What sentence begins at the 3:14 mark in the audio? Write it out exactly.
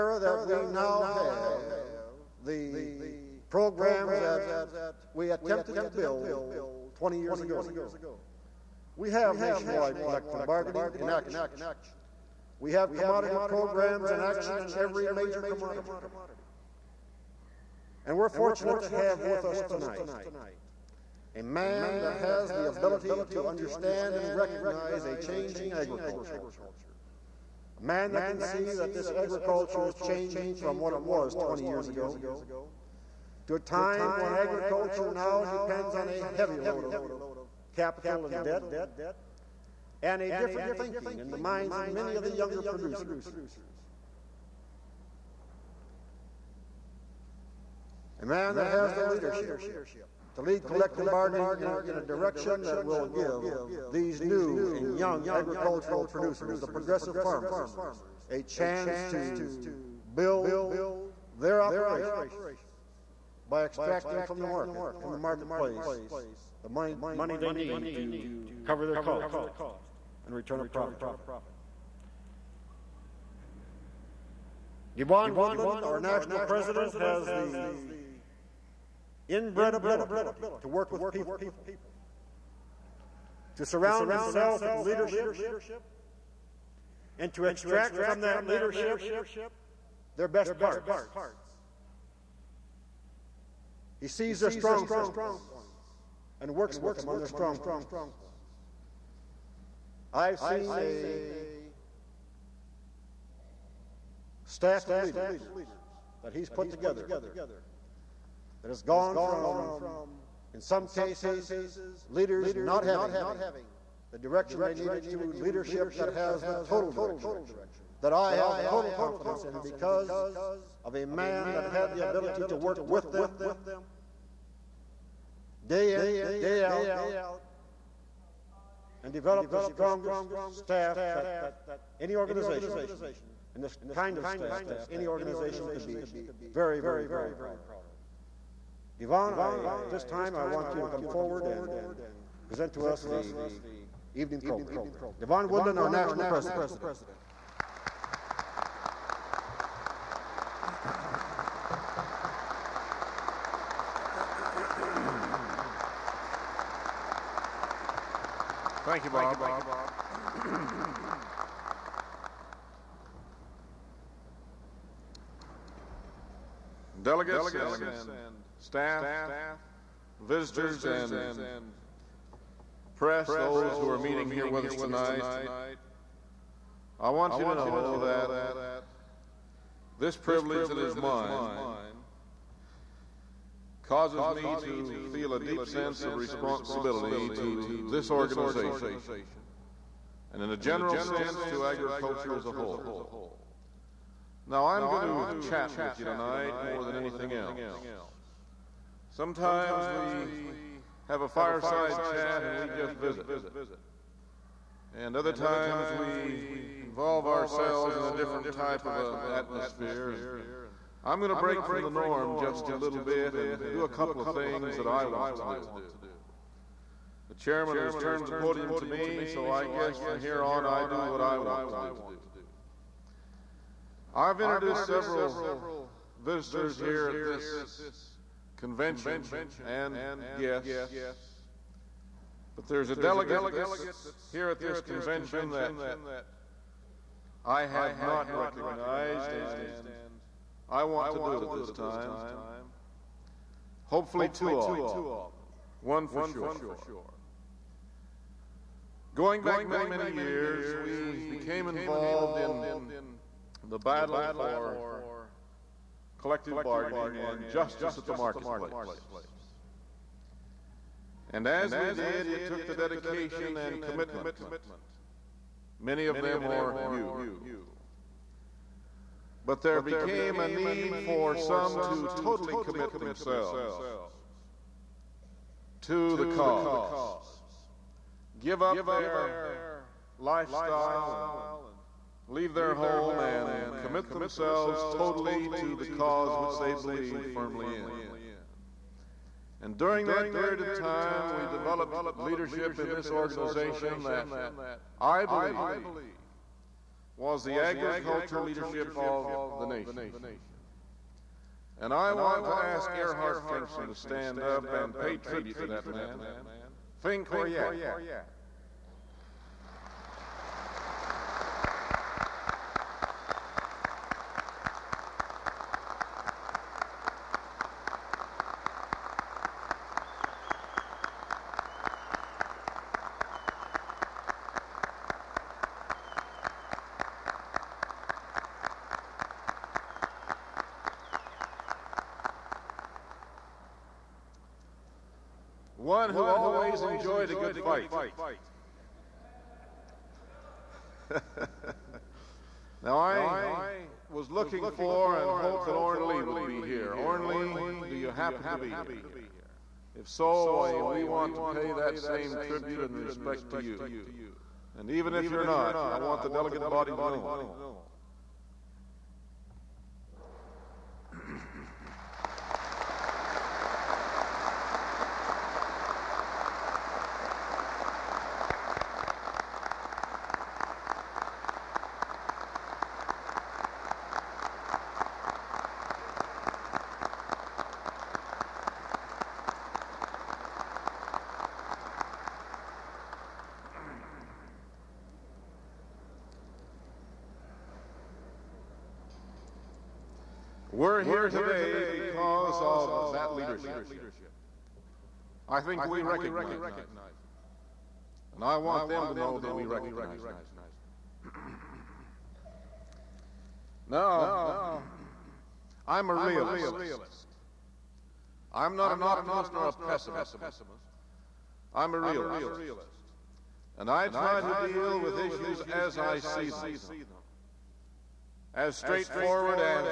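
Now, I'm going to chat with you tonight more than anything else.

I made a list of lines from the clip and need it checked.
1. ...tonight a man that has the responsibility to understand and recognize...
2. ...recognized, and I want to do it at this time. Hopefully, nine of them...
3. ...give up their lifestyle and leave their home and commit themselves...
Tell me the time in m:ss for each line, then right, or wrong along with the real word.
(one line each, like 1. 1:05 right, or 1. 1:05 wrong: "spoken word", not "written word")
1. 0:19 wrong: "ability", not "responsibility"
2. 3:58 wrong: "two", not "nine"
3. 4:38 right.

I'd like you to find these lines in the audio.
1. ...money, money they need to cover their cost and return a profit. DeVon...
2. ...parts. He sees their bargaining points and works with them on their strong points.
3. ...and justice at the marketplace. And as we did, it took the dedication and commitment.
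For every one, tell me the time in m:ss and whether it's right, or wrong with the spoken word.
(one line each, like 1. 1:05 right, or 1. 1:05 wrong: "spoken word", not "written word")
1. 1:06 right
2. 1:30 wrong: "strong", not "bargaining"
3. 4:17 right.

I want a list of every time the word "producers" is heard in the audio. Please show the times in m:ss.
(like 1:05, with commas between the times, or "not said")
0:42, 0:56.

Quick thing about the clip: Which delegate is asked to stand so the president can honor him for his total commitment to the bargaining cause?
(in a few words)
Erhard Pfingsten.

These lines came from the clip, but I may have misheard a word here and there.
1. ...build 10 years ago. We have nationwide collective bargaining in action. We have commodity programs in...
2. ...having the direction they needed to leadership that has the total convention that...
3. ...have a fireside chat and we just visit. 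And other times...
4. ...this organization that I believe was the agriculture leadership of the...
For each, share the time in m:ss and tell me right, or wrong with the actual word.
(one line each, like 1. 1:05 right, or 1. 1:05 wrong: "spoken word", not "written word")
1. 0:05 wrong: "20", not "10"
2. 1:52 wrong: "direction", not "convention"
3. 3:21 right
4. 4:52 right.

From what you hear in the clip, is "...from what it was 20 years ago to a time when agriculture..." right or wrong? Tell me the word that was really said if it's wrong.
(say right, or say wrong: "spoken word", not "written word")
right.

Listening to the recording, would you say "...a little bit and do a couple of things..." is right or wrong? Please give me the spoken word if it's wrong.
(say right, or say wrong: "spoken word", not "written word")
right.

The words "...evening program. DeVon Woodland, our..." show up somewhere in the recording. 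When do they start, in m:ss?
2:24.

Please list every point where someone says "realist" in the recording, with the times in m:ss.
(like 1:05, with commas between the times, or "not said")
6:46, 6:51.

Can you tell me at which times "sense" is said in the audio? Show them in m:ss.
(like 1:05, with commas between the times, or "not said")
3:05, 3:10.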